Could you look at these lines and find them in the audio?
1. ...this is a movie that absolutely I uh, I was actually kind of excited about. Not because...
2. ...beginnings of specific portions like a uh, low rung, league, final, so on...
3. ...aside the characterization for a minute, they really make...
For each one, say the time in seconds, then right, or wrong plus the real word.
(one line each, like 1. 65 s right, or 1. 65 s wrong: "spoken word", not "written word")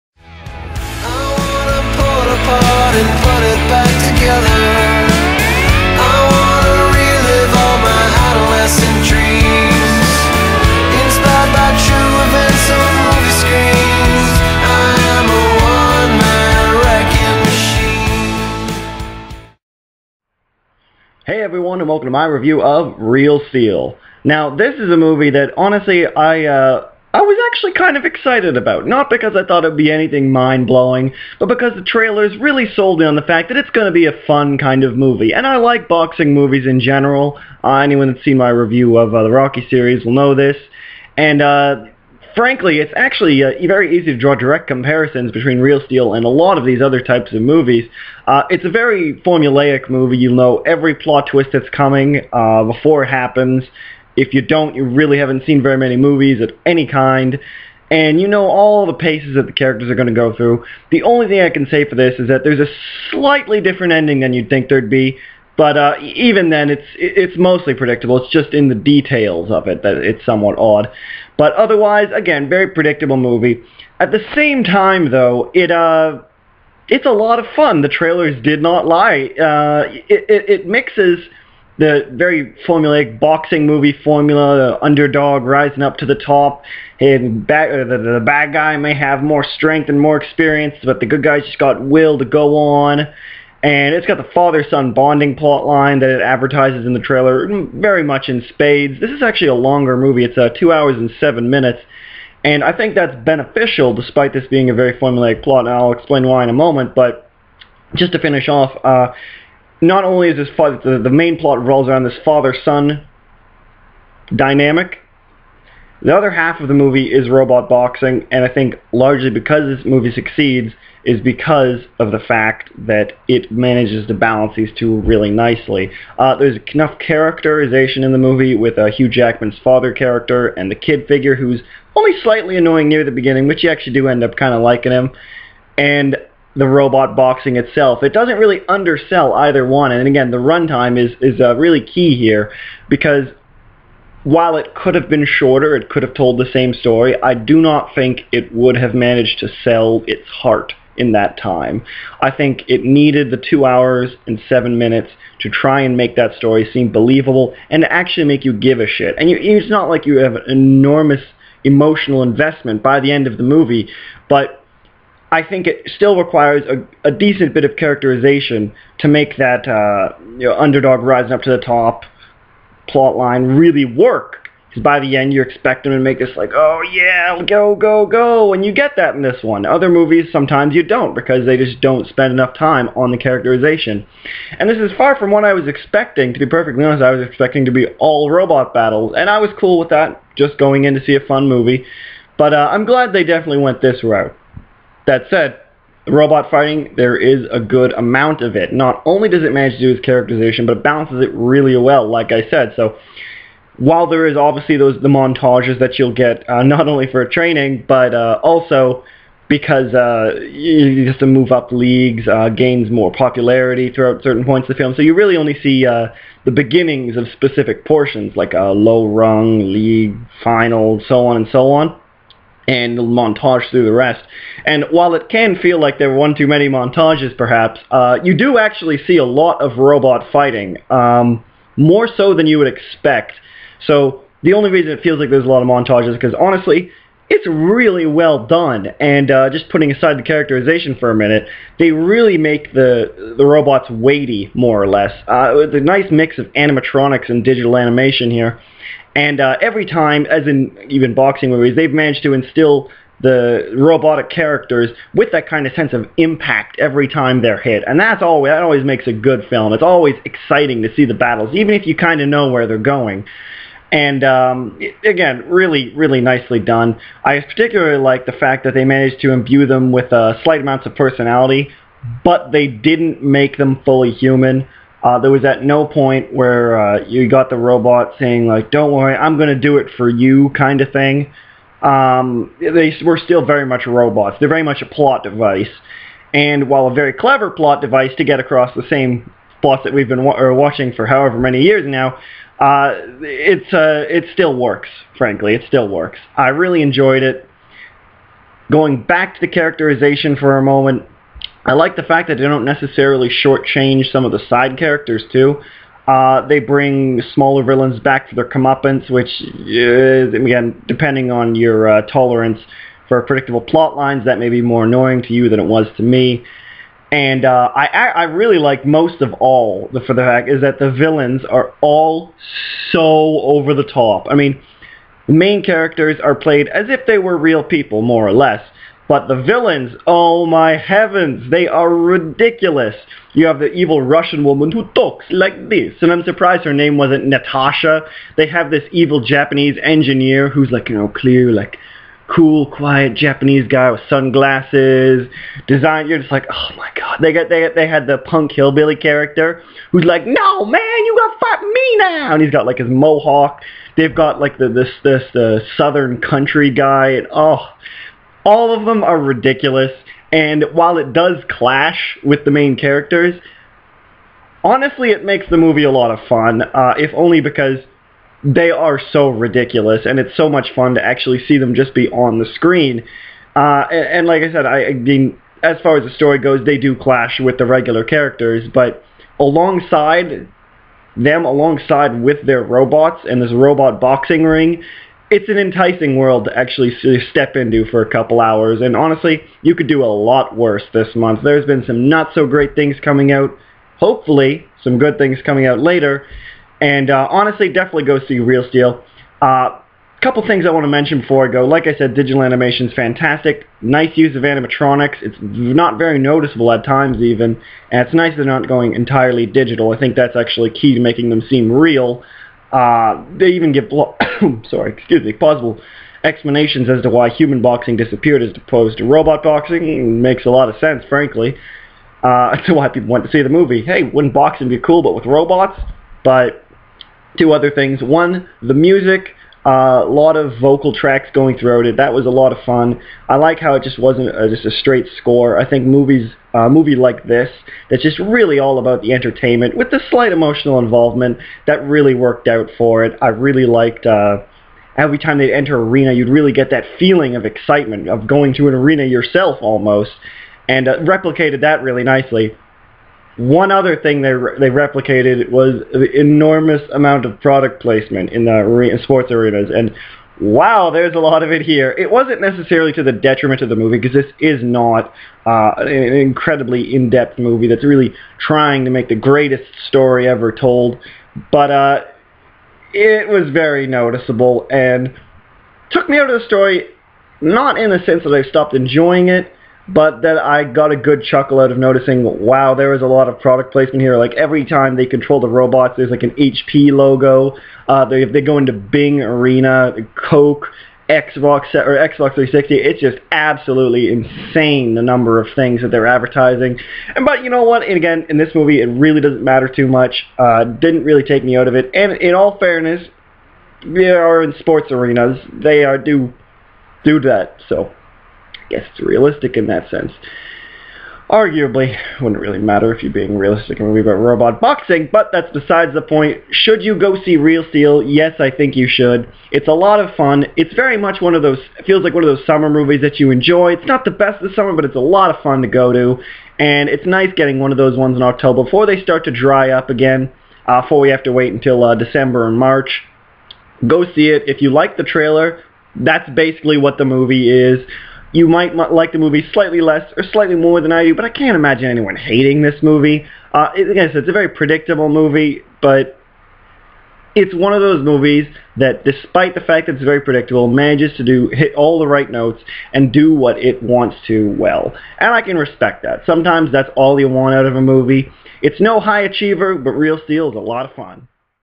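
1. 24 s wrong: "honestly", not "absolutely"
2. 216 s right
3. 239 s right.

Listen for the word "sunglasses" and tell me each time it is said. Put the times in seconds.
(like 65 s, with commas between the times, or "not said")
344 s.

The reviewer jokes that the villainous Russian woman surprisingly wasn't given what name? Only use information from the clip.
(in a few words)
Natasha.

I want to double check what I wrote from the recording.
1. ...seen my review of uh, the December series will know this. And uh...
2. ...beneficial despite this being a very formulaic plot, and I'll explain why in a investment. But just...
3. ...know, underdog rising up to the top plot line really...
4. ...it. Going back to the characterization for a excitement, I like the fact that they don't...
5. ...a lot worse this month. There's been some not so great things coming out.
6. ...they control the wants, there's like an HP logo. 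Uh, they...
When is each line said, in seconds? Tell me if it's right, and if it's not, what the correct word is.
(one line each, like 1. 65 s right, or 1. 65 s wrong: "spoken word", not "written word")
1. 38 s wrong: "Rocky", not "December"
2. 103 s wrong: "moment", not "investment"
3. 170 s right
4. 297 s wrong: "moment", not "excitement"
5. 390 s right
6. 484 s wrong: "robots", not "wants".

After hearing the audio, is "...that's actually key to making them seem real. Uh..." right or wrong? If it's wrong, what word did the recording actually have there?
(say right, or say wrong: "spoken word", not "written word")
right.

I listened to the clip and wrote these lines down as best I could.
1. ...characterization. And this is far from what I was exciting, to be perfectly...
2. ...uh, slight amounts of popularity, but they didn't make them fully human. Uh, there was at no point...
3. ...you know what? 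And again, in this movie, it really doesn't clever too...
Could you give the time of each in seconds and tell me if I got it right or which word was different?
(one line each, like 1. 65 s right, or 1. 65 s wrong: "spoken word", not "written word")
1. 183 s wrong: "expecting", not "exciting"
2. 270 s wrong: "personality", not "popularity"
3. 497 s wrong: "matter", not "clever".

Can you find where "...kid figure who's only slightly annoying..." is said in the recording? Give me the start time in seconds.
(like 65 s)
130 s.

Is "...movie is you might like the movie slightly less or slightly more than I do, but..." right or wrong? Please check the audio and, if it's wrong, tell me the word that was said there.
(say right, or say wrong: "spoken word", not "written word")
right.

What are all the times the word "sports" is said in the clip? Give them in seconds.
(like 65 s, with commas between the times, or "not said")
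459 s, 504 s.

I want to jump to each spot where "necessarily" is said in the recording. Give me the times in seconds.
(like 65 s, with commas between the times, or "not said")
302 s, 462 s.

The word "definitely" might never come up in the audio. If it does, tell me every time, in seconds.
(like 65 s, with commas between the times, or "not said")
193 s, 397 s.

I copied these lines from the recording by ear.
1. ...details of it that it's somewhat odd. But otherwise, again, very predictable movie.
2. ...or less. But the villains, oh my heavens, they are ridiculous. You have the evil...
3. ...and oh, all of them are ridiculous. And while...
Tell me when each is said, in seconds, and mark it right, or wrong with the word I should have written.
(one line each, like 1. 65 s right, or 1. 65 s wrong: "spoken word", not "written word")
1. 68 s right
2. 328 s right
3. 357 s right.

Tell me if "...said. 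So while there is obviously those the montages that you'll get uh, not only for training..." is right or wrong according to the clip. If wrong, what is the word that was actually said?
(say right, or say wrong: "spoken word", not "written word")
right.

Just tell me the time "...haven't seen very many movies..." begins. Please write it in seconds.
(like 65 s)
55 s.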